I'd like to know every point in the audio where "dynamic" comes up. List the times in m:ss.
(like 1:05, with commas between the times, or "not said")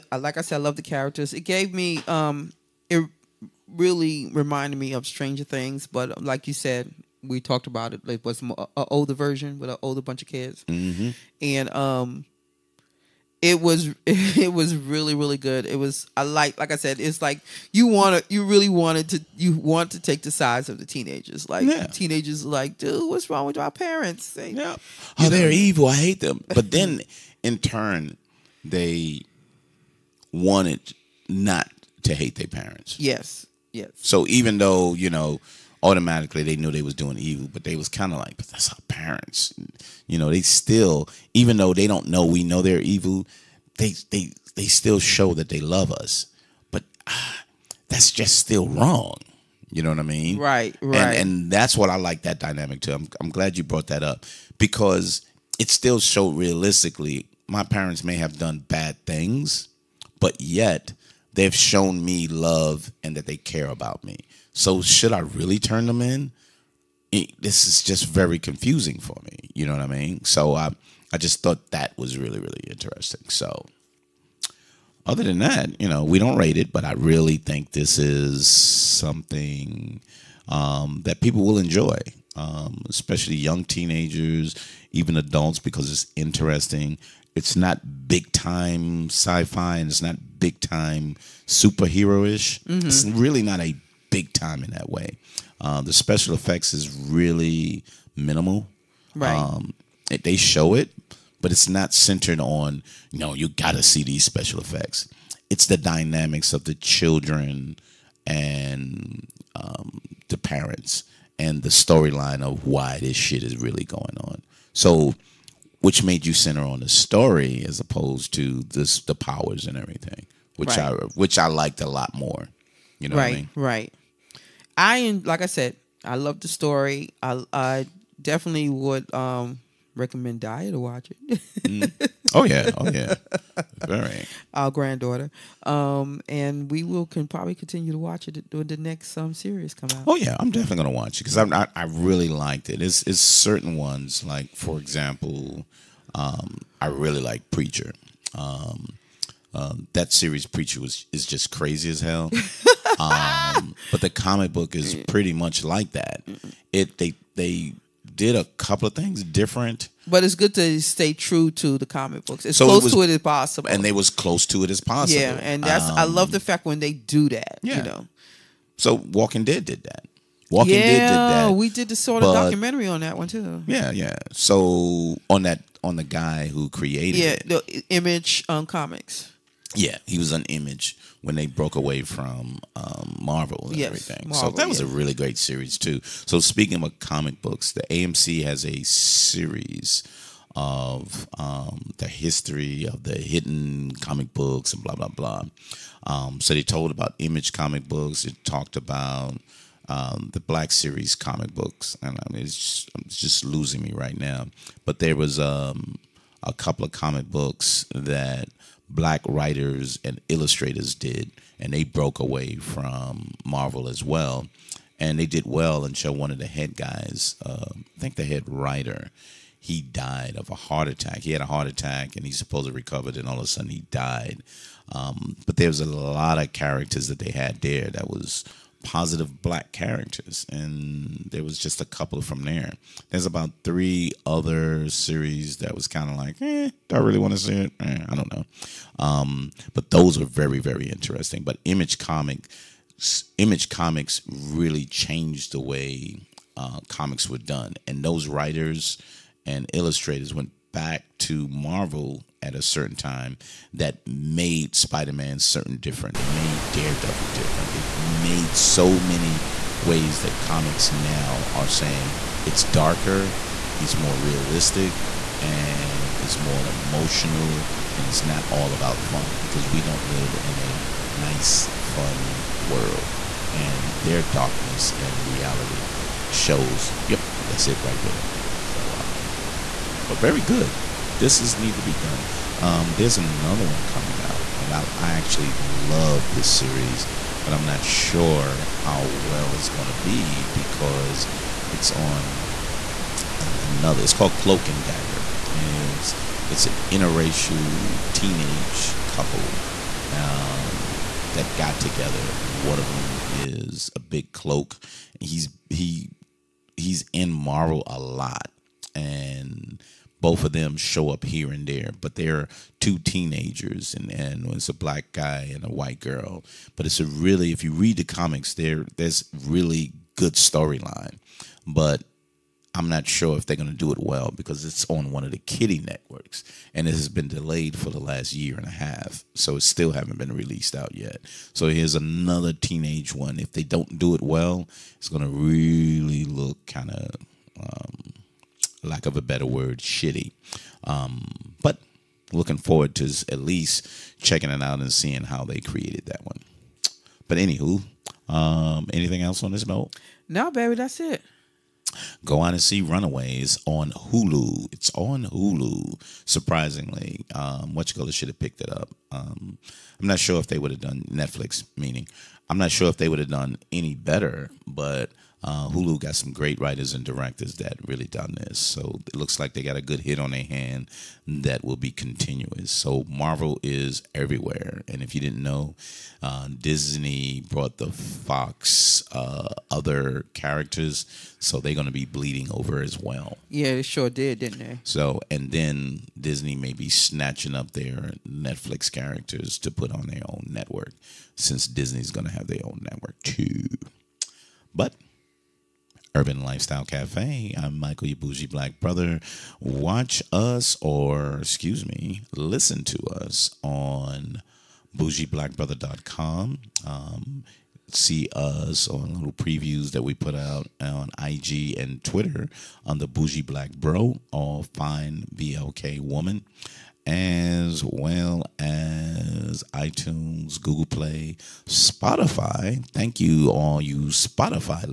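0:52, 1:45.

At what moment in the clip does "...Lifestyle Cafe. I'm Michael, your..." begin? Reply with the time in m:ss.
6:36.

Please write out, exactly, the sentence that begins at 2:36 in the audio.
It they they did a couple of things different.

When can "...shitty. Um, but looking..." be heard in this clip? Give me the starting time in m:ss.
5:39.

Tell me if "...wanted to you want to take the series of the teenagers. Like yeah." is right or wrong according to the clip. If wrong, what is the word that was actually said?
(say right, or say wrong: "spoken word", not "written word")
wrong: "sides", not "series".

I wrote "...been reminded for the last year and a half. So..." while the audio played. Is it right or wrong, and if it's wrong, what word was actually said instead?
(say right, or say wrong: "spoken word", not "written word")
wrong: "delayed", not "reminded".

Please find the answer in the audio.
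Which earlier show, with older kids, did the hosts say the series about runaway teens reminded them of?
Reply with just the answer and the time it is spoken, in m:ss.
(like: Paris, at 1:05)
Stranger Things, at 0:05.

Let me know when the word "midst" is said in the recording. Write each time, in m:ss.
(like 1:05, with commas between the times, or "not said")
not said.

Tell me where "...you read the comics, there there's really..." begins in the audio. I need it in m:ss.
5:17.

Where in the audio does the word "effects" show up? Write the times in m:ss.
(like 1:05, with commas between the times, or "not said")
1:36, 1:44.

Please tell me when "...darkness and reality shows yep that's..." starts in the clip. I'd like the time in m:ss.
4:34.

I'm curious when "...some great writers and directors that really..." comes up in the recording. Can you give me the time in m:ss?
6:06.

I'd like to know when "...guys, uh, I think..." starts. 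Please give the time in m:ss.
3:36.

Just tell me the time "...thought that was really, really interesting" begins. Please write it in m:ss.
1:11.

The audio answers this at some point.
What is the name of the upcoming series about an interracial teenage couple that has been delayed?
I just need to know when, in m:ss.
4:54.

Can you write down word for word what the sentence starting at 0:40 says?
You know, they still, even though they don't know we know they're evil, they they they still show that they love us.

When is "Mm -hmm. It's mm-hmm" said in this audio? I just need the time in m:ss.
1:32.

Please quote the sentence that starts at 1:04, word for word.
So should I really turn them in?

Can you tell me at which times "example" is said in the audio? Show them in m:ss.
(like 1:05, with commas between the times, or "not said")
2:24.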